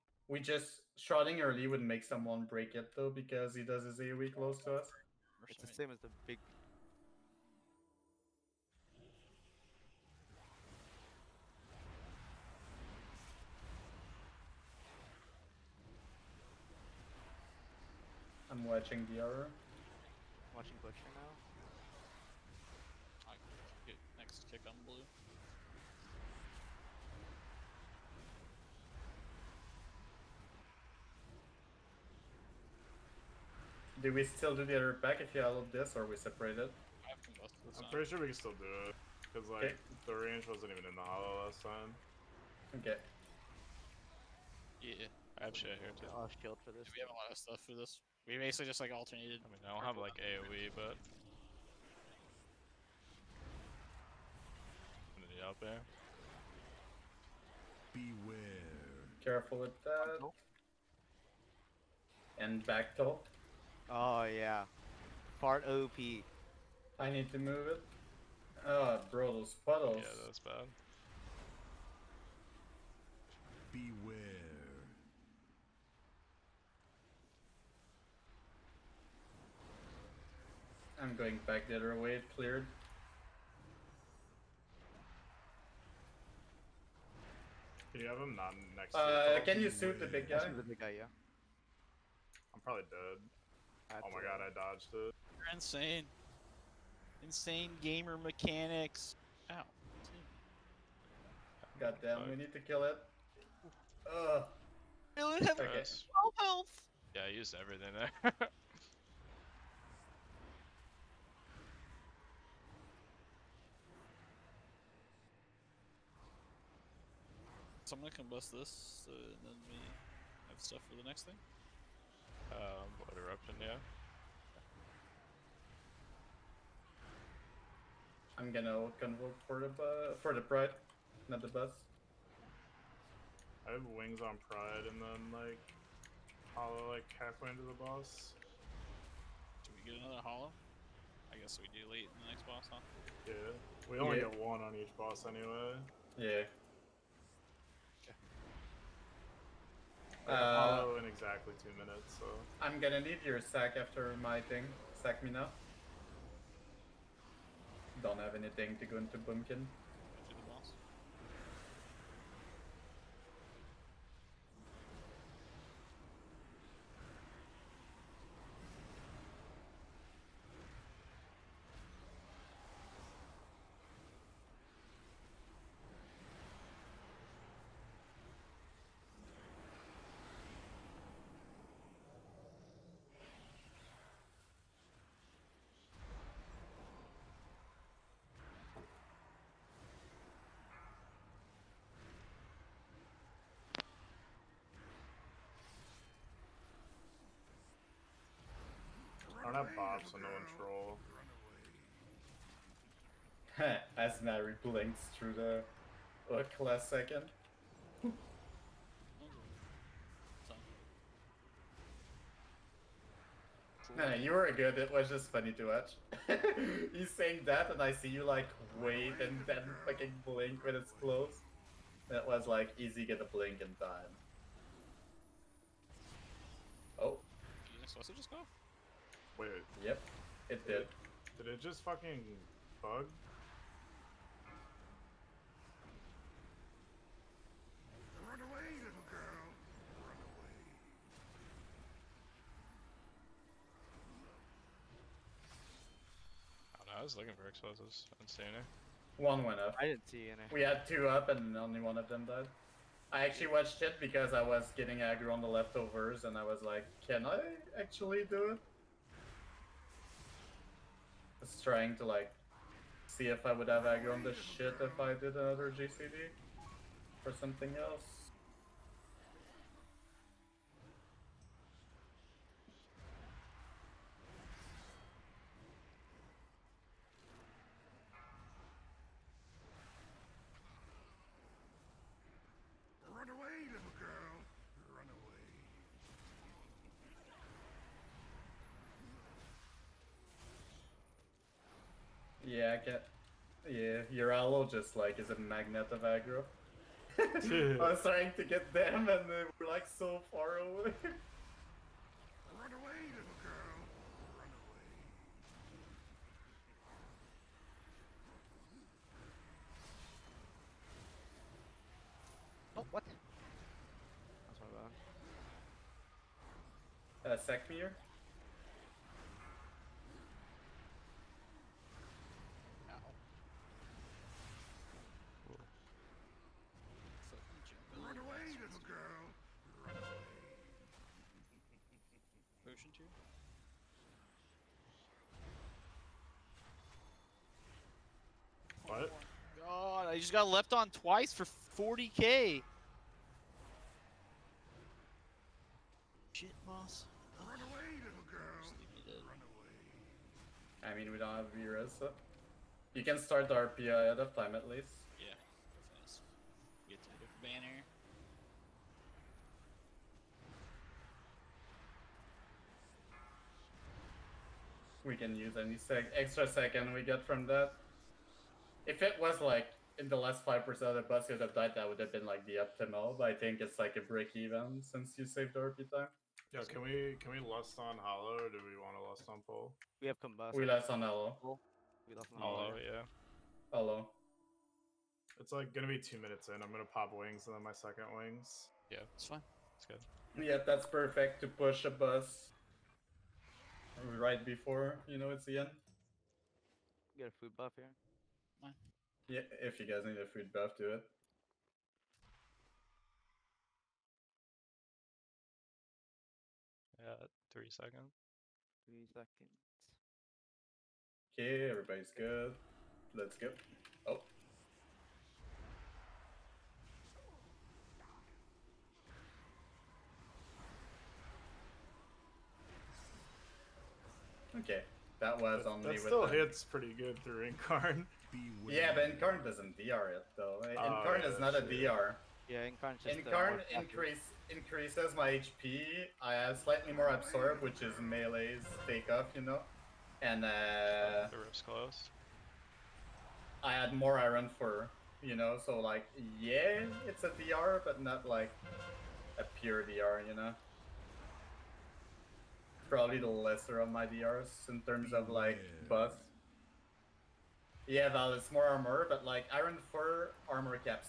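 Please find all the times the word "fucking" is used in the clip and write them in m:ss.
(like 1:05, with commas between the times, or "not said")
3:39, 3:51.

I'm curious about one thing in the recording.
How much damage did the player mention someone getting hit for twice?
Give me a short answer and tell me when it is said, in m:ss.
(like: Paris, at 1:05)
40k, at 5:41.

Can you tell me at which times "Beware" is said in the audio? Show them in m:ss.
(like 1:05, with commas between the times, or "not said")
0:57, 1:13.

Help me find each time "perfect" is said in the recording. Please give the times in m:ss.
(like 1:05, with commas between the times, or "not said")
6:30.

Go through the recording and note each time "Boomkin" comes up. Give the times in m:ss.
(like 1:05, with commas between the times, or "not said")
2:39.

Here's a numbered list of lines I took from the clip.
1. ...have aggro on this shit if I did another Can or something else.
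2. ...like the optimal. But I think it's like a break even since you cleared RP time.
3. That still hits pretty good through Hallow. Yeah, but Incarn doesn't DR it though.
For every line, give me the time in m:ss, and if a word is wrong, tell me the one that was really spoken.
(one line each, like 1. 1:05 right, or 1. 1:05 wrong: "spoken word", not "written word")
1. 4:23 wrong: "GCD", not "Can"
2. 6:12 wrong: "saved", not "cleared"
3. 7:05 wrong: "Incarn", not "Hallow".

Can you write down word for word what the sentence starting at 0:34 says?
Do we still do the other pack if you have this, or we separate it?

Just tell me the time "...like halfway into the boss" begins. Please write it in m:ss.
2:16.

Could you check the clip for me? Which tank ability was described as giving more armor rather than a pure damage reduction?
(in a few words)
Iron fur.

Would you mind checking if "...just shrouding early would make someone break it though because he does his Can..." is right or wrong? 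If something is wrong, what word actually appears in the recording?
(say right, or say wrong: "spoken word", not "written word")
wrong: "AoE", not "Can".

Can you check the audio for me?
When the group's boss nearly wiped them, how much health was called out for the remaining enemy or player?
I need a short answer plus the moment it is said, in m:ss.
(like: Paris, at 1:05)
12 health, at 1:45.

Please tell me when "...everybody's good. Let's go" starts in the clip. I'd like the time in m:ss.
6:51.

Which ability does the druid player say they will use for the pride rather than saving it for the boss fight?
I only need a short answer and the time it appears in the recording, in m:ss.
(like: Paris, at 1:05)
Convoke, at 2:08.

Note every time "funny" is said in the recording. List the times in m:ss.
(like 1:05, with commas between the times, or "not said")
3:35.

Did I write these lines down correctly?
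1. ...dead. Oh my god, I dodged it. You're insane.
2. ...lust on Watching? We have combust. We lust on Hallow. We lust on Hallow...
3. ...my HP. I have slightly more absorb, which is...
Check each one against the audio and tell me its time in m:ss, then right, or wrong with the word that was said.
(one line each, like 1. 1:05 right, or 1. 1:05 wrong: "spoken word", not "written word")
1. 1:32 right
2. 6:19 wrong: "Pole", not "Watching"
3. 7:15 right.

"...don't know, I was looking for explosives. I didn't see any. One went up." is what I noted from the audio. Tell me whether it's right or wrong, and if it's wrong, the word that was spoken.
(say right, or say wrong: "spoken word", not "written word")
right.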